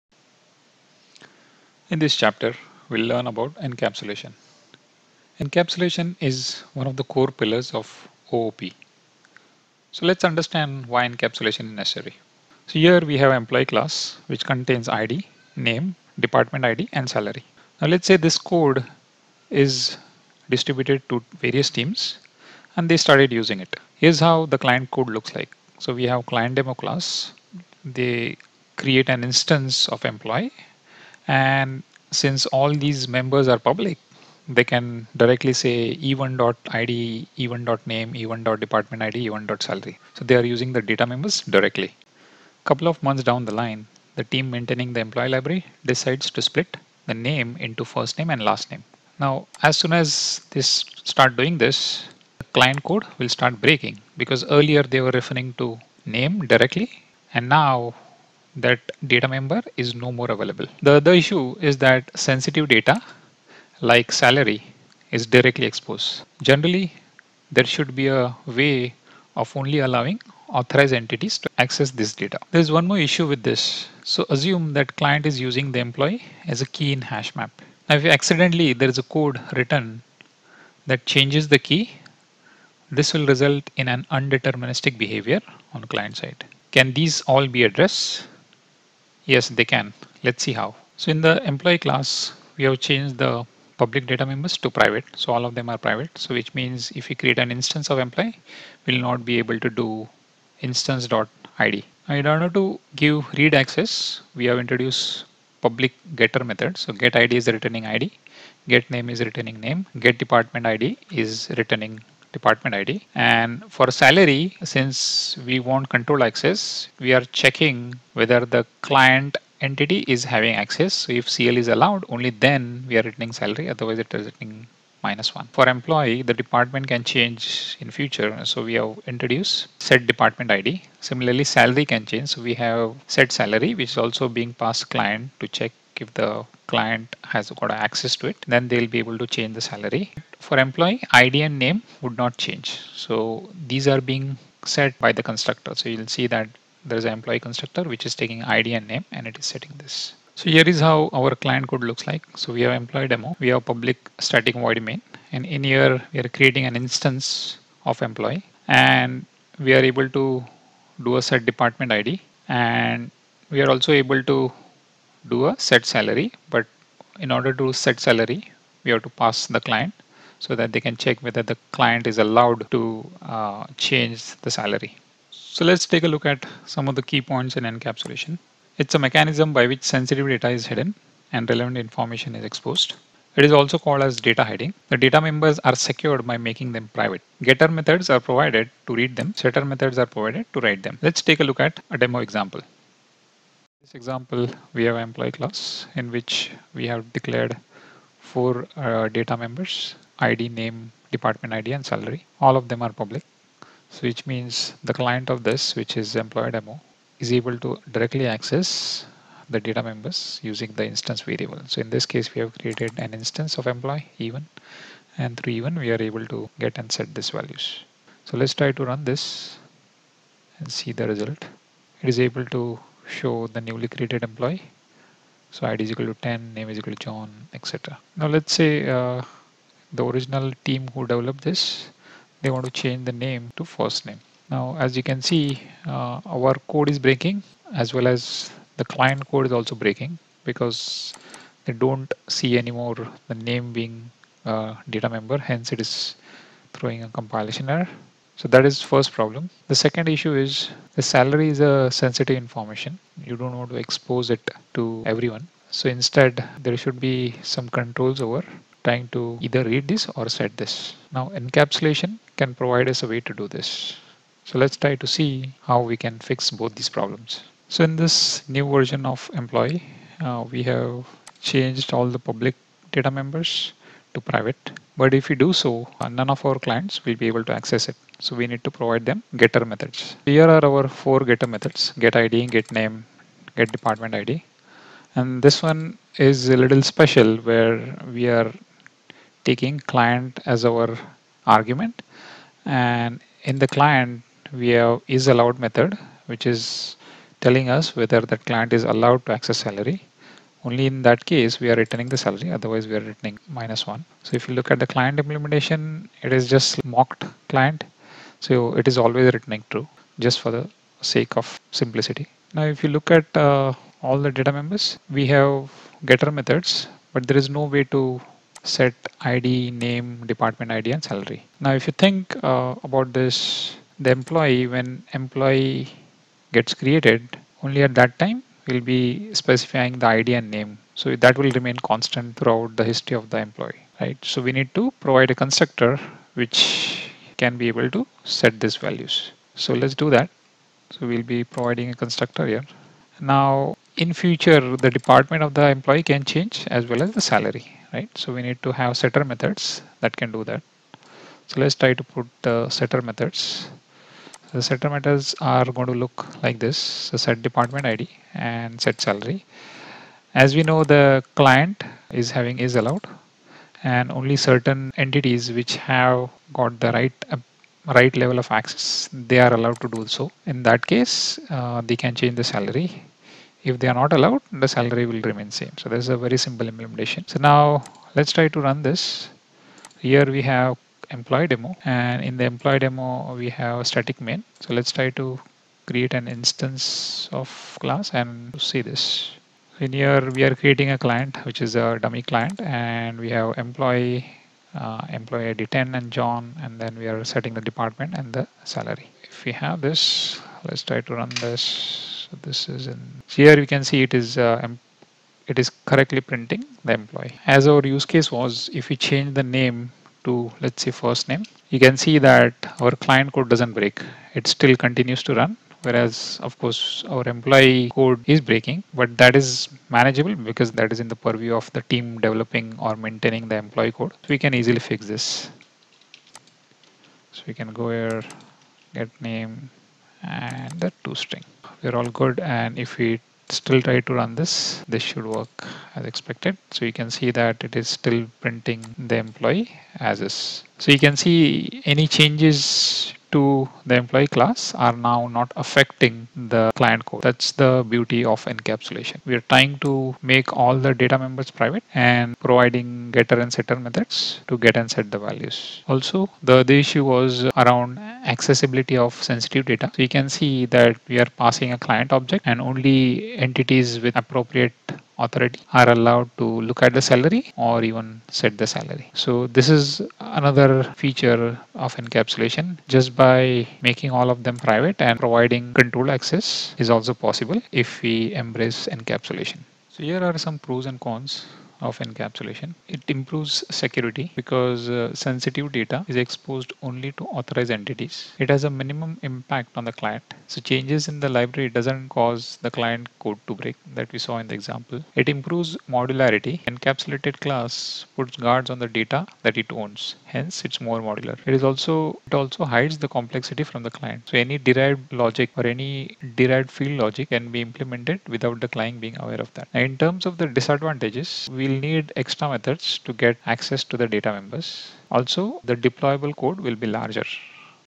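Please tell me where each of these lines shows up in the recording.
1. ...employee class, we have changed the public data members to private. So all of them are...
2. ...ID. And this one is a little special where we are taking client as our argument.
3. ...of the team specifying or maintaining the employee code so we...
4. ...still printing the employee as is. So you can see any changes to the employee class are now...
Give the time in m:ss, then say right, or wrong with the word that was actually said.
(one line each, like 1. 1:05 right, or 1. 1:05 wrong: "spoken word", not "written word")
1. 1:31 right
2. 4:44 right
3. 7:01 wrong: "developing", not "specifying"
4. 7:17 right.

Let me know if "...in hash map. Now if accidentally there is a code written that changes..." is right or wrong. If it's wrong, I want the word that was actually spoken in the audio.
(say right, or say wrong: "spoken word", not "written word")
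right.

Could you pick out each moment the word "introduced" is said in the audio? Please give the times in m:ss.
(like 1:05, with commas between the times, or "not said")
1:44, 2:09.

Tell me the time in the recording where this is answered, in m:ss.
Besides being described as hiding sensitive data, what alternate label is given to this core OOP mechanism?
3:04.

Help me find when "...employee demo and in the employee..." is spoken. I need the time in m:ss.
6:21.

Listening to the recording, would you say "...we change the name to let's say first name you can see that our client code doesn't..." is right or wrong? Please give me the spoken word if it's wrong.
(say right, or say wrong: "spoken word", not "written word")
right.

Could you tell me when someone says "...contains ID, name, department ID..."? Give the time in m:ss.
0:14.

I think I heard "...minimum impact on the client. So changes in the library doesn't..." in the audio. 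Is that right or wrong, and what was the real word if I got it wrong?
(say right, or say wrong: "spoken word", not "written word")
right.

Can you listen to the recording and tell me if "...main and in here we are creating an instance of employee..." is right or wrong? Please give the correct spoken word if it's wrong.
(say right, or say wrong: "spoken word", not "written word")
right.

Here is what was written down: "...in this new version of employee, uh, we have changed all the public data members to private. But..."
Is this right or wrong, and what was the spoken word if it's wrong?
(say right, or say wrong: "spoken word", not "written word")
right.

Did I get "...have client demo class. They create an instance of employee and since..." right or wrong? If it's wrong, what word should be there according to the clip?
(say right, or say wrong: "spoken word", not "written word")
right.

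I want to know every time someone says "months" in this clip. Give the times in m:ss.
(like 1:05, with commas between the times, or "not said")
0:43.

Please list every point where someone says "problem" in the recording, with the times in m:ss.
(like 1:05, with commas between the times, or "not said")
4:09, 4:26.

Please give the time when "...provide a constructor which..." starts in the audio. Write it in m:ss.
5:34.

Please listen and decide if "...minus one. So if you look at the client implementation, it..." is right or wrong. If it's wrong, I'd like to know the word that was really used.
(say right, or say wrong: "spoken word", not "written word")
right.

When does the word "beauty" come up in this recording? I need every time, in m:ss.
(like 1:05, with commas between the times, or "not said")
7:27.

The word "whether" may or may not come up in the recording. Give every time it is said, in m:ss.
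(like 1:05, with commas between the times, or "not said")
1:58, 2:51, 4:57.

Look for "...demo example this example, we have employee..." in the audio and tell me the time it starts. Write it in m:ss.
3:11.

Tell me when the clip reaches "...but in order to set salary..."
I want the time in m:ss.
2:46.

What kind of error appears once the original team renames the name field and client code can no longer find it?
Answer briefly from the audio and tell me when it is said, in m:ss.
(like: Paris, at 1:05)
compilation error, at 4:07.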